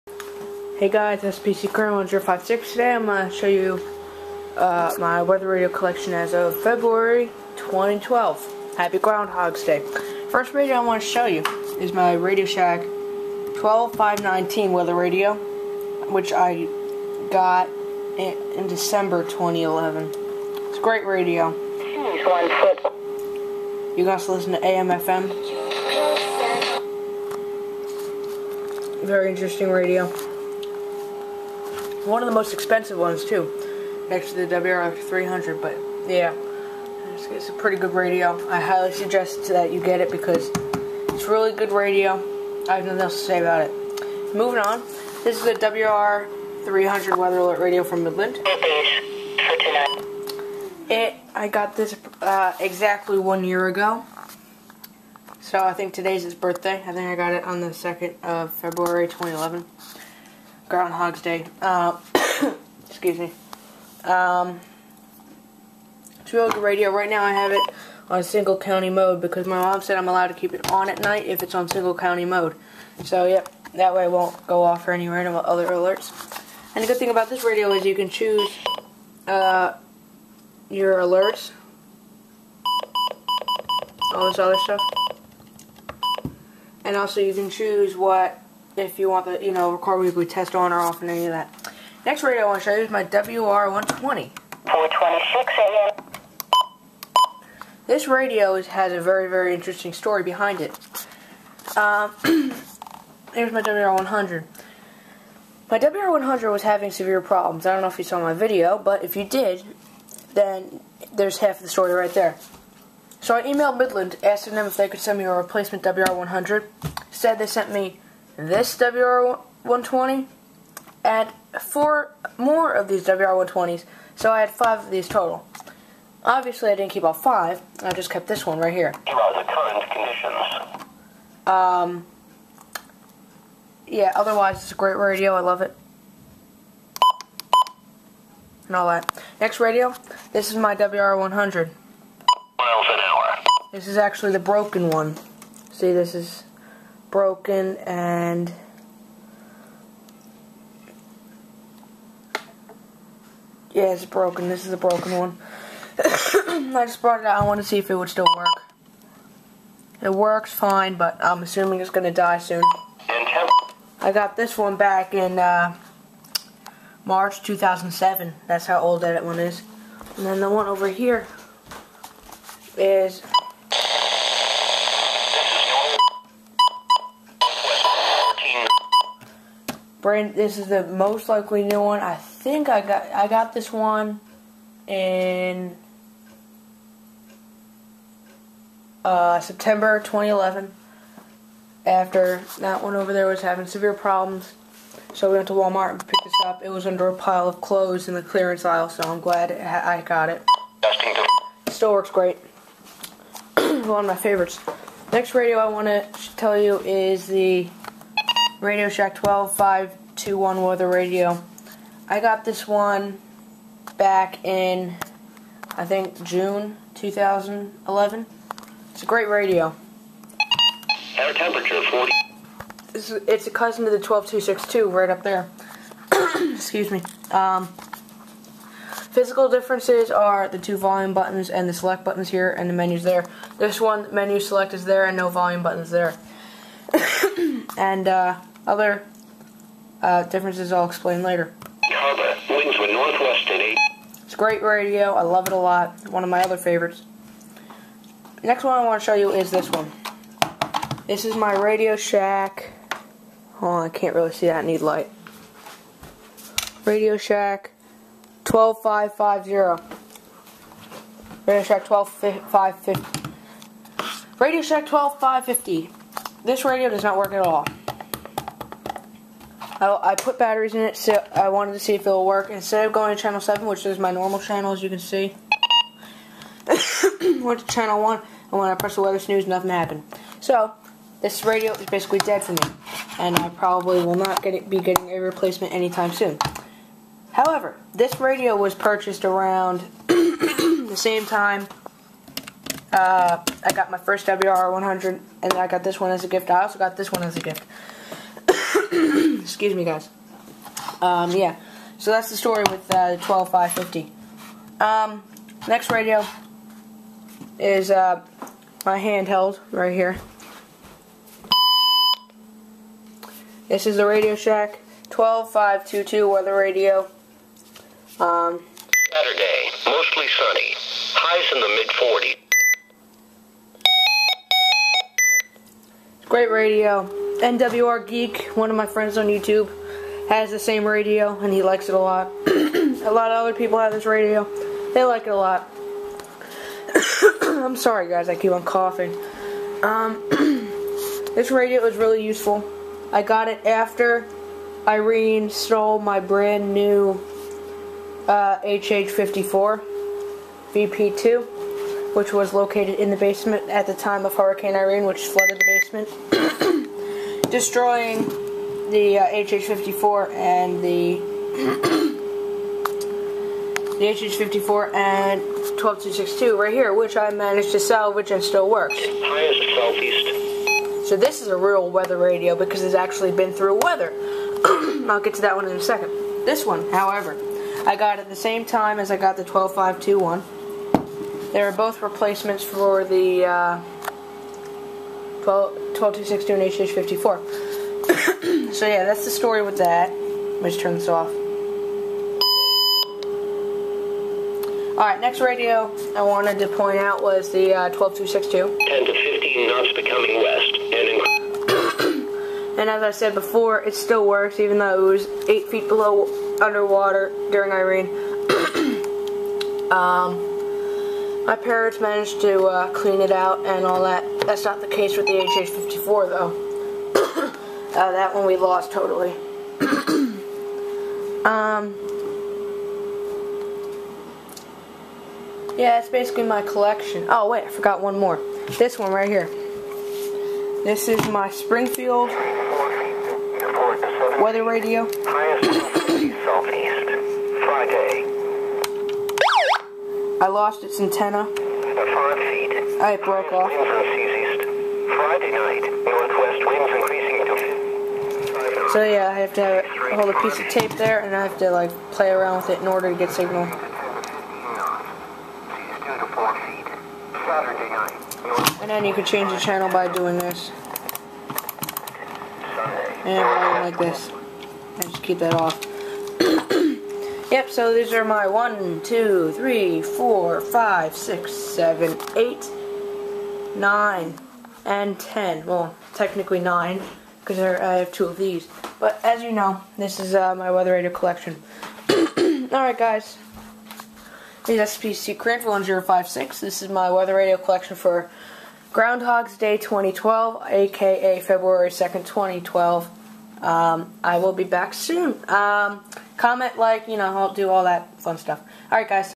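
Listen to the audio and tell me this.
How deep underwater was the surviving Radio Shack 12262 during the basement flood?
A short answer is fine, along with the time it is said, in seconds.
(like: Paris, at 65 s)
8 feet, at 405 s.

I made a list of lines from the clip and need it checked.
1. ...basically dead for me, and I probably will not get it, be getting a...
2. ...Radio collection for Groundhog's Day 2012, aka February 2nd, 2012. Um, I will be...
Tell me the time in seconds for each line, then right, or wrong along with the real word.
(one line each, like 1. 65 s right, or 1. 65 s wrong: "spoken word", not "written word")
1. 281 s right
2. 487 s right.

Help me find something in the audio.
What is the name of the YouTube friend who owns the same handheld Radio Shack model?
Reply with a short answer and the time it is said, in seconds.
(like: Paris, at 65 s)
NWR Geek, at 327 s.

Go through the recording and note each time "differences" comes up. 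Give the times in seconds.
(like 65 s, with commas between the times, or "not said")
229 s, 240 s.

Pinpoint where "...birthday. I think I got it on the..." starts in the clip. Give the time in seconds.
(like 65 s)
56 s.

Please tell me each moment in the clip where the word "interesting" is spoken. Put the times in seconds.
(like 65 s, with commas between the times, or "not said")
29 s, 99 s.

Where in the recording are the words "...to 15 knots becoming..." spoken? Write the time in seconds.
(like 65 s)
399 s.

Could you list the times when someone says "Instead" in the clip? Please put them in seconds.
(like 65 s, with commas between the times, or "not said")
117 s, 272 s.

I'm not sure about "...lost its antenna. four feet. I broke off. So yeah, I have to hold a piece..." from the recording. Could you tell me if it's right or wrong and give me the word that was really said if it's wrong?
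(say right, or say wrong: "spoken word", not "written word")
wrong: "five", not "four".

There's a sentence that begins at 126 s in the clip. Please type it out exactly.
Obviously, I didn't keep all five.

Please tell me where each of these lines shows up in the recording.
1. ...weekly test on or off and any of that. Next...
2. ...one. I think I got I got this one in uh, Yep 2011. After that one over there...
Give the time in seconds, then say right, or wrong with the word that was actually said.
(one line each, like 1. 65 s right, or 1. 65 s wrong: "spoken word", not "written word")
1. 89 s right
2. 181 s wrong: "September", not "Yep".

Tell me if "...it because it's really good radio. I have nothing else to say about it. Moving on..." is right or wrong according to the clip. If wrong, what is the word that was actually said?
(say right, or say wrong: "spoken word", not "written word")
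right.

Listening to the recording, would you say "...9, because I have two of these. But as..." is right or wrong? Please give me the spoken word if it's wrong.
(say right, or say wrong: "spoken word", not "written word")
right.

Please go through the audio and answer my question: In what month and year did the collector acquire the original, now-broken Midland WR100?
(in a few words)
March 2007.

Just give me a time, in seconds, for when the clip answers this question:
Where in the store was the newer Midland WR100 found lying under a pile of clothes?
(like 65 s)
198 s.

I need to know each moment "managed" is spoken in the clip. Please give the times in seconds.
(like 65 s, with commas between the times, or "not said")
367 s, 411 s.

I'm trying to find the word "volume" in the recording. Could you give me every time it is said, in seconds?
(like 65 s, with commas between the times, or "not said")
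230 s, 235 s.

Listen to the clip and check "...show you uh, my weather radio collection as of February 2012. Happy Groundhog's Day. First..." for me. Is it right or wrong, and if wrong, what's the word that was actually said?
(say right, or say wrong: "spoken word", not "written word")
right.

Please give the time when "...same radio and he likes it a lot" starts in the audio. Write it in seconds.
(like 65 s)
330 s.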